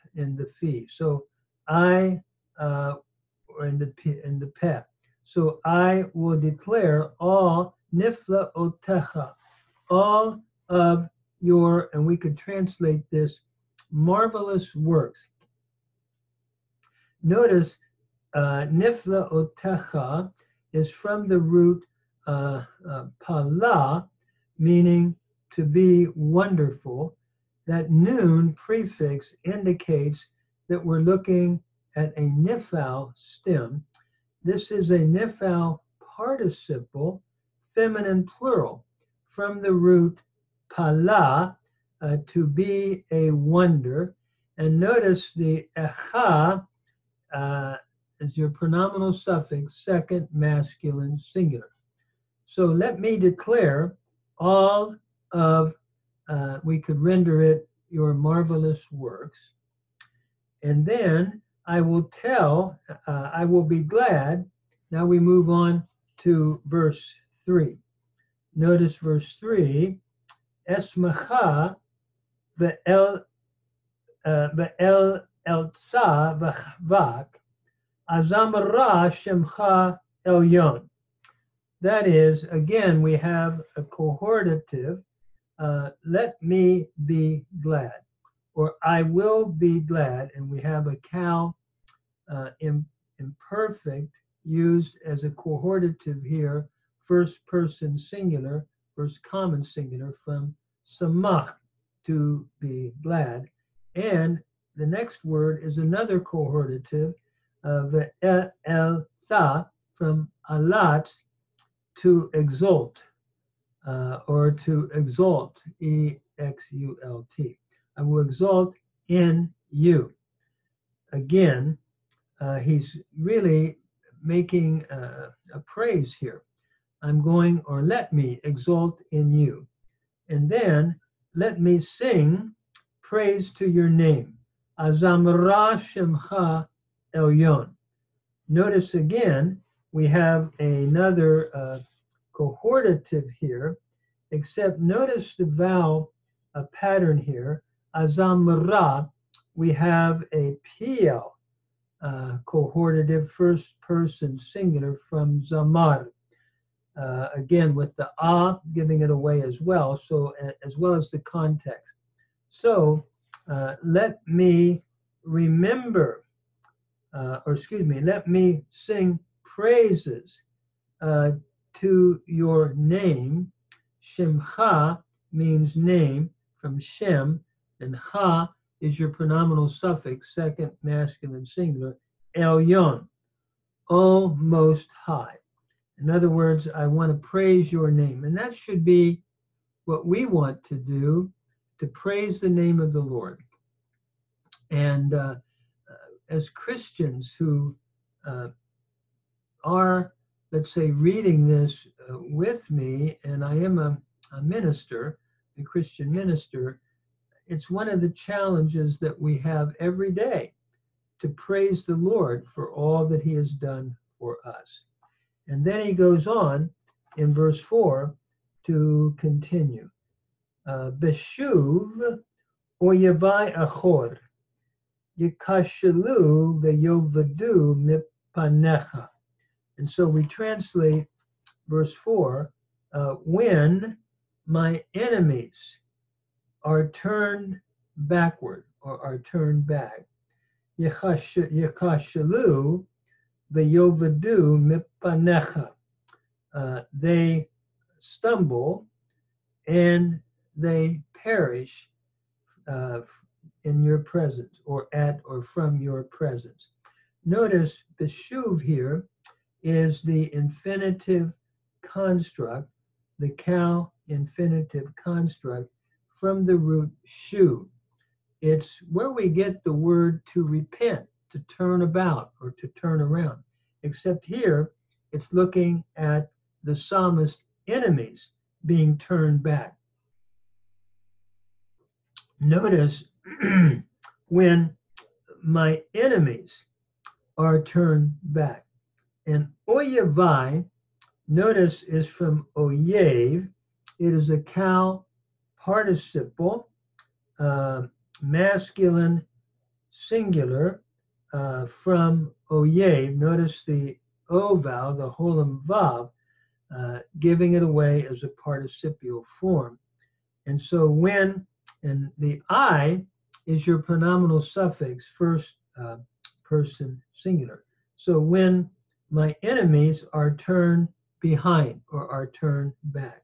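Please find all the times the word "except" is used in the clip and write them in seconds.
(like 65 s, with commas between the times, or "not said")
144 s, 273 s.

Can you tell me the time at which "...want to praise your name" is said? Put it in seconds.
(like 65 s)
186 s.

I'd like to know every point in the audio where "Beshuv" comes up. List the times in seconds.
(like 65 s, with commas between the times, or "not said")
220 s, 258 s.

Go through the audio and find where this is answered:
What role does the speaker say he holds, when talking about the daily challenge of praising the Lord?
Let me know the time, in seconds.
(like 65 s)
205 s.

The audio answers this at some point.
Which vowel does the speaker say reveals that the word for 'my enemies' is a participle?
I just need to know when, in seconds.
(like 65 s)
305 s.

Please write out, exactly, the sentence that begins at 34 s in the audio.
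This is a nifal participle, feminine plural, from the root pala, uh, to be a wonder.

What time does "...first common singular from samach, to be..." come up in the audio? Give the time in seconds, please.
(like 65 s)
98 s.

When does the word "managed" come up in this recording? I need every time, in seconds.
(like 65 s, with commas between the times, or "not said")
not said.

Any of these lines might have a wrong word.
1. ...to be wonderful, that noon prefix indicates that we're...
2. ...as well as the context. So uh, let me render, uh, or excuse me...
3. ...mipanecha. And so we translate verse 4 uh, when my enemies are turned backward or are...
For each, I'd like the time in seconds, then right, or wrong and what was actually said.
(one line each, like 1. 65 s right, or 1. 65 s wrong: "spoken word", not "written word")
1. 25 s right
2. 160 s wrong: "remember", not "render"
3. 228 s right.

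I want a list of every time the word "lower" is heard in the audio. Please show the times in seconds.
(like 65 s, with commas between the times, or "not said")
not said.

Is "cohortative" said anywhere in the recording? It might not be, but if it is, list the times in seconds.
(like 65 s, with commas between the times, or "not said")
83 s, 95 s, 106 s, 142 s, 152 s.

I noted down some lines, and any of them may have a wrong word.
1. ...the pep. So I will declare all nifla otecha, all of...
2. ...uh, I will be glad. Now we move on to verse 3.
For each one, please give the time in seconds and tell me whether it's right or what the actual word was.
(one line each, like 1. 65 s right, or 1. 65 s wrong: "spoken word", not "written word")
1. 4 s right
2. 63 s right.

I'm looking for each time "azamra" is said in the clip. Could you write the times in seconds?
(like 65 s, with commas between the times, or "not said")
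78 s, 134 s, 147 s.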